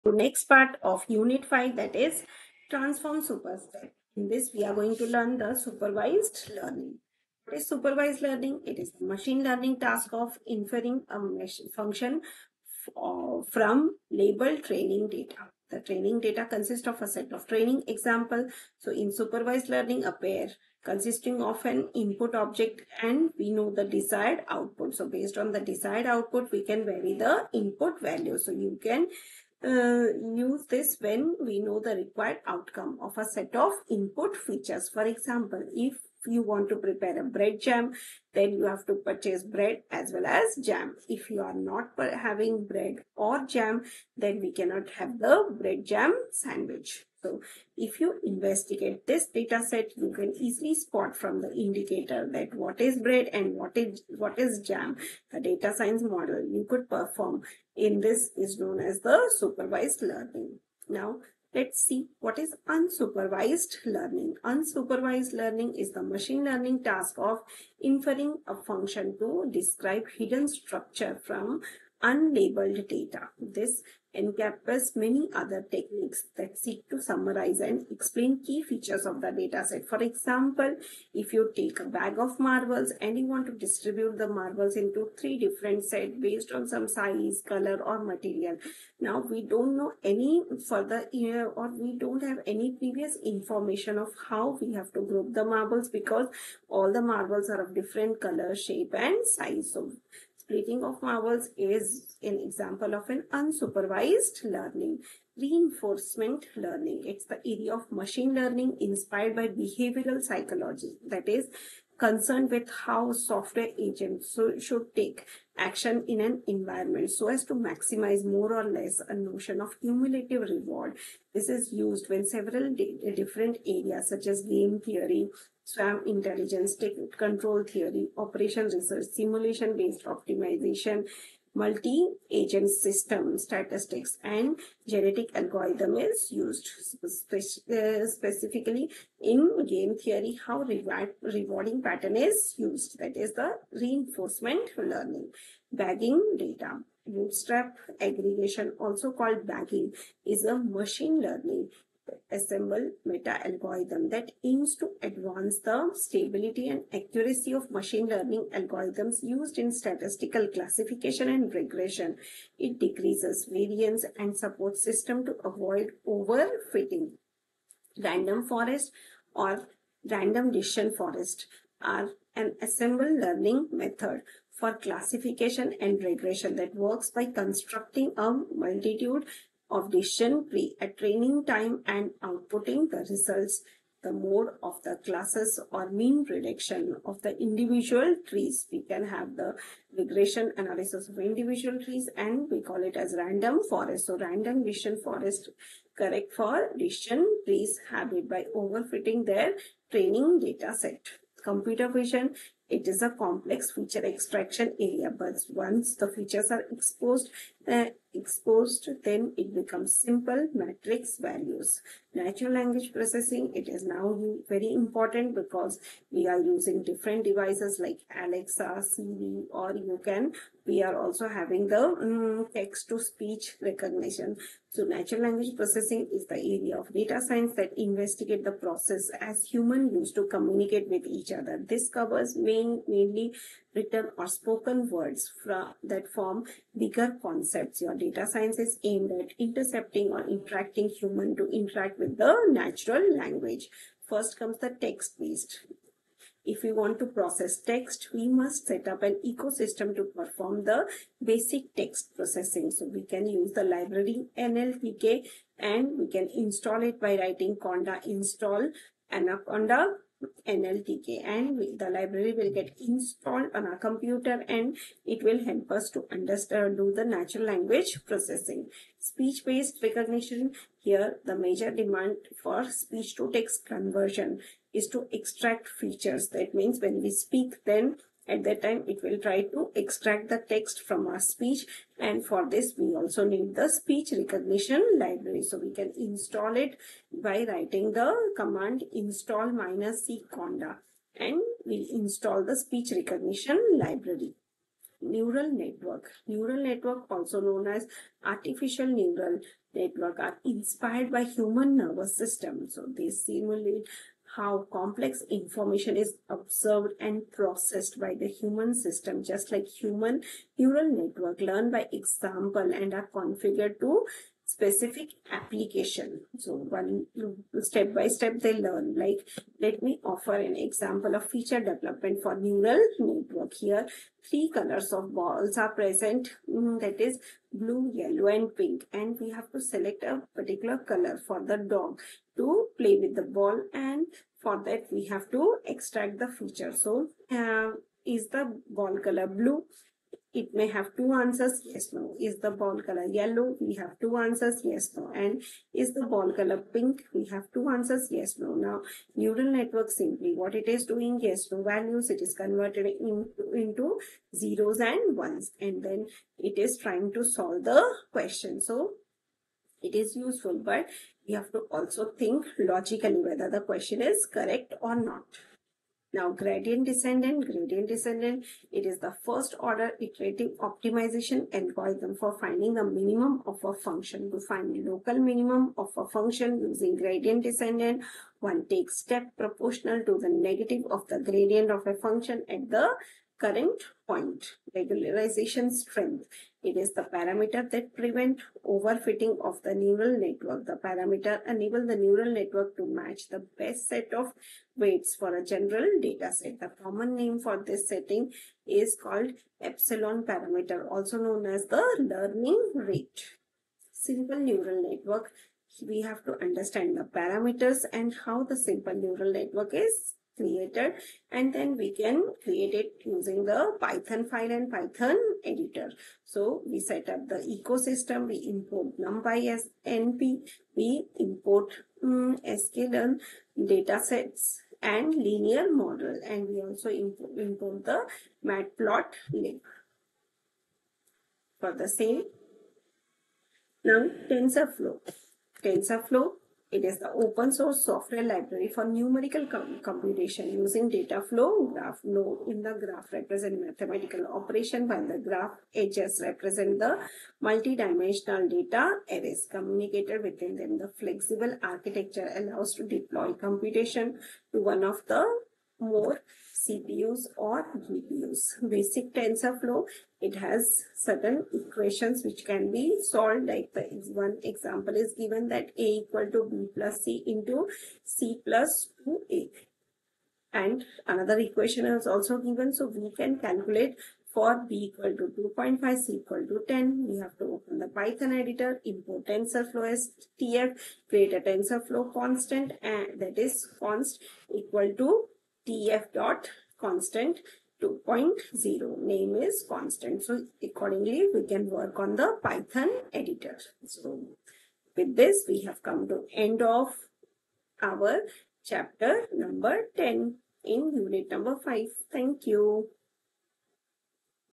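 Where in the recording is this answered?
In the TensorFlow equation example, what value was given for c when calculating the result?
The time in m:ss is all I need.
7:55.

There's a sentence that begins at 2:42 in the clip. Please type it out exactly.
It decreases variance and supports system to avoid overfitting.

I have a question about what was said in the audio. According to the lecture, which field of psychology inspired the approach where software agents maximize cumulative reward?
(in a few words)
behavioral psychology.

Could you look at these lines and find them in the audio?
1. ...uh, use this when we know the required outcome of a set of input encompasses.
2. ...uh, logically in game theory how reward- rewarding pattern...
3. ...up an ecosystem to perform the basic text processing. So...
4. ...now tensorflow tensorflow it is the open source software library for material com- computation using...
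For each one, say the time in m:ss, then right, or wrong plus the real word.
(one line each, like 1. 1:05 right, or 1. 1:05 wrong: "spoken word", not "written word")
1. 0:29 wrong: "features", not "encompasses"
2. 2:17 wrong: "specifically", not "logically"
3. 4:08 right
4. 7:13 wrong: "numerical", not "material".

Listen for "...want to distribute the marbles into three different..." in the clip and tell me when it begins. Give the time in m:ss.
1:23.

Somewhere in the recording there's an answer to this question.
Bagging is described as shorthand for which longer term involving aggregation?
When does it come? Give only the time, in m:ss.
2:27.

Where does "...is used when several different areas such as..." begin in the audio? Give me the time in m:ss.
2:01.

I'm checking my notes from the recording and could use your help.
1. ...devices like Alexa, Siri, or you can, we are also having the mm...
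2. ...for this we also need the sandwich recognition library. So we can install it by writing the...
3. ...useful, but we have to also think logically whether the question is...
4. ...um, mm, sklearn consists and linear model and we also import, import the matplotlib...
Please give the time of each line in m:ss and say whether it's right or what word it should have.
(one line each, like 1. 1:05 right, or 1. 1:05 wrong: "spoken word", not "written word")
1. 3:37 right
2. 4:42 wrong: "speech", not "sandwich"
3. 6:00 right
4. 7:02 wrong: "datasets", not "consists".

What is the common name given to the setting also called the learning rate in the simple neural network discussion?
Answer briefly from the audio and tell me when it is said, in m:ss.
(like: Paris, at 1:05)
epsilon, at 6:39.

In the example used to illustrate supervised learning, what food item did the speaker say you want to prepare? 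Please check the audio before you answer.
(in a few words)
bread jam sandwich.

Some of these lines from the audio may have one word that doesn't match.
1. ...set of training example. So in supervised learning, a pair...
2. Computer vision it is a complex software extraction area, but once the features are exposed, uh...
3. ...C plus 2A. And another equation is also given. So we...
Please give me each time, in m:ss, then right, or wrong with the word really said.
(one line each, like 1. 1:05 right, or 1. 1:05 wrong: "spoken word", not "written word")
1. 0:17 right
2. 3:21 wrong: "feature", not "software"
3. 7:48 right.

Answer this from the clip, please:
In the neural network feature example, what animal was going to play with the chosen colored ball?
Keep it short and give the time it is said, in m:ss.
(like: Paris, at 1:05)
dog, at 5:31.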